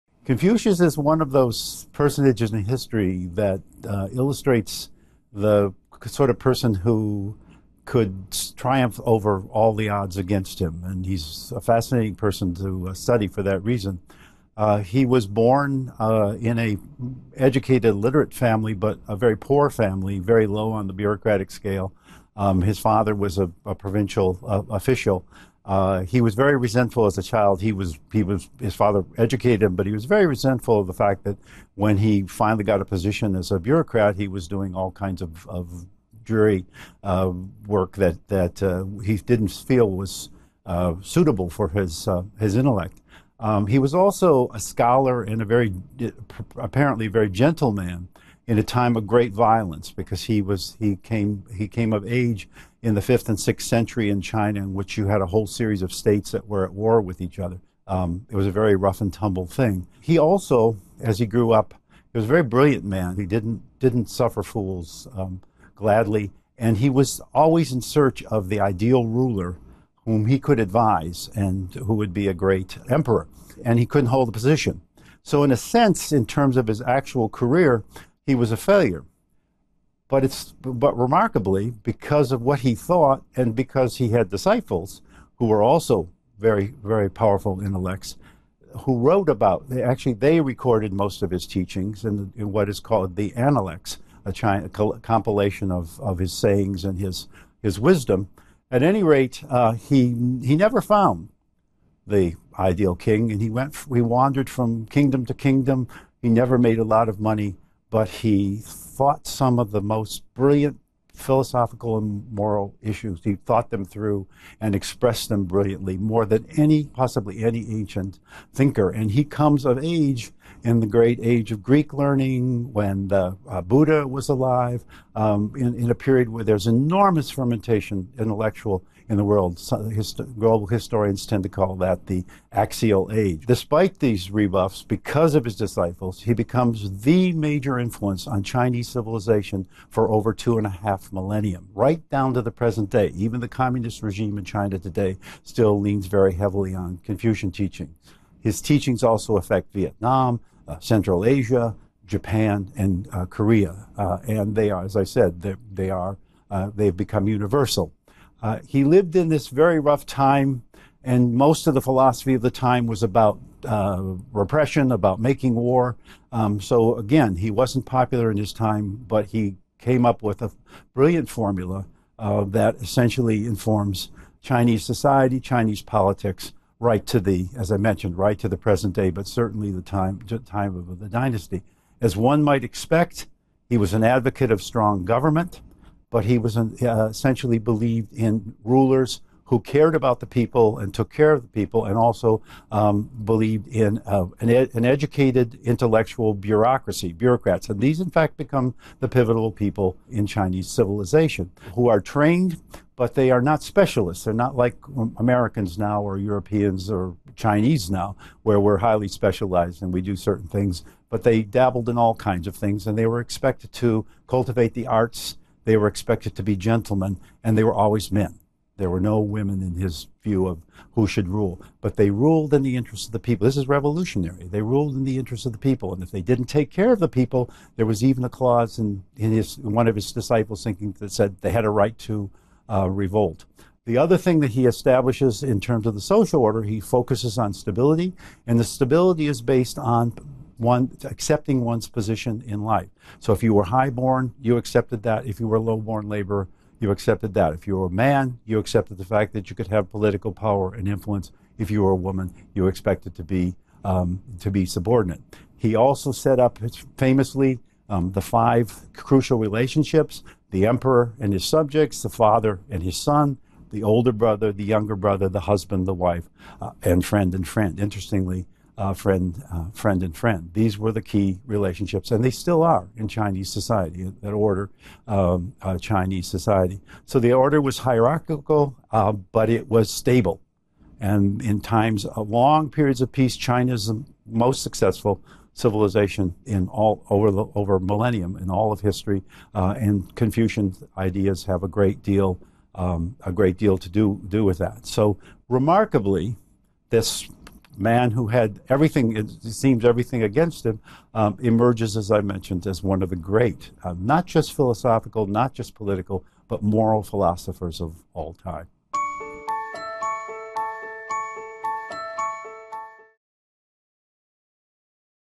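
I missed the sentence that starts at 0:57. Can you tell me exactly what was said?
Um, it was a very rough and tumble thing.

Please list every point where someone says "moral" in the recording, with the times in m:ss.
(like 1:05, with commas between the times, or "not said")
1:52, 5:06.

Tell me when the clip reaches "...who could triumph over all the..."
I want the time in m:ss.
0:06.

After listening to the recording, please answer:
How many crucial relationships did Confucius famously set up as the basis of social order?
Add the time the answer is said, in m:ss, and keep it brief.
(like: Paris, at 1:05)
5, at 4:18.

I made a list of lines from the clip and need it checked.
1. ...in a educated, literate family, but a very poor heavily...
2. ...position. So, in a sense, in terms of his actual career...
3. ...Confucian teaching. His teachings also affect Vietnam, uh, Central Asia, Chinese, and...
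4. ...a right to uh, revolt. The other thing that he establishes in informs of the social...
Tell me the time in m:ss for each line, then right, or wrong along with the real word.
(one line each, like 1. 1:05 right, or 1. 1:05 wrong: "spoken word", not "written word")
1. 0:16 wrong: "family", not "heavily"
2. 1:14 right
3. 2:27 wrong: "Japan", not "Chinese"
4. 3:51 wrong: "terms", not "informs".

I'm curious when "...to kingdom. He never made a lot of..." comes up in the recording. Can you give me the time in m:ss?
1:45.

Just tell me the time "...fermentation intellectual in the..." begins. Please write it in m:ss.
2:07.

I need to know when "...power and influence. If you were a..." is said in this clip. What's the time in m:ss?
4:10.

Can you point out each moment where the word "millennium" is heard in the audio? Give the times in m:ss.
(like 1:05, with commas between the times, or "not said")
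2:21, 4:47.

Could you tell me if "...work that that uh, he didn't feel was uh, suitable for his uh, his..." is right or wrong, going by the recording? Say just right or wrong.
right.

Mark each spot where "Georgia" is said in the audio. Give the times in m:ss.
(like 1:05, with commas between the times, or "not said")
not said.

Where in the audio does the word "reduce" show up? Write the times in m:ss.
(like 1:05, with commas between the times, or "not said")
not said.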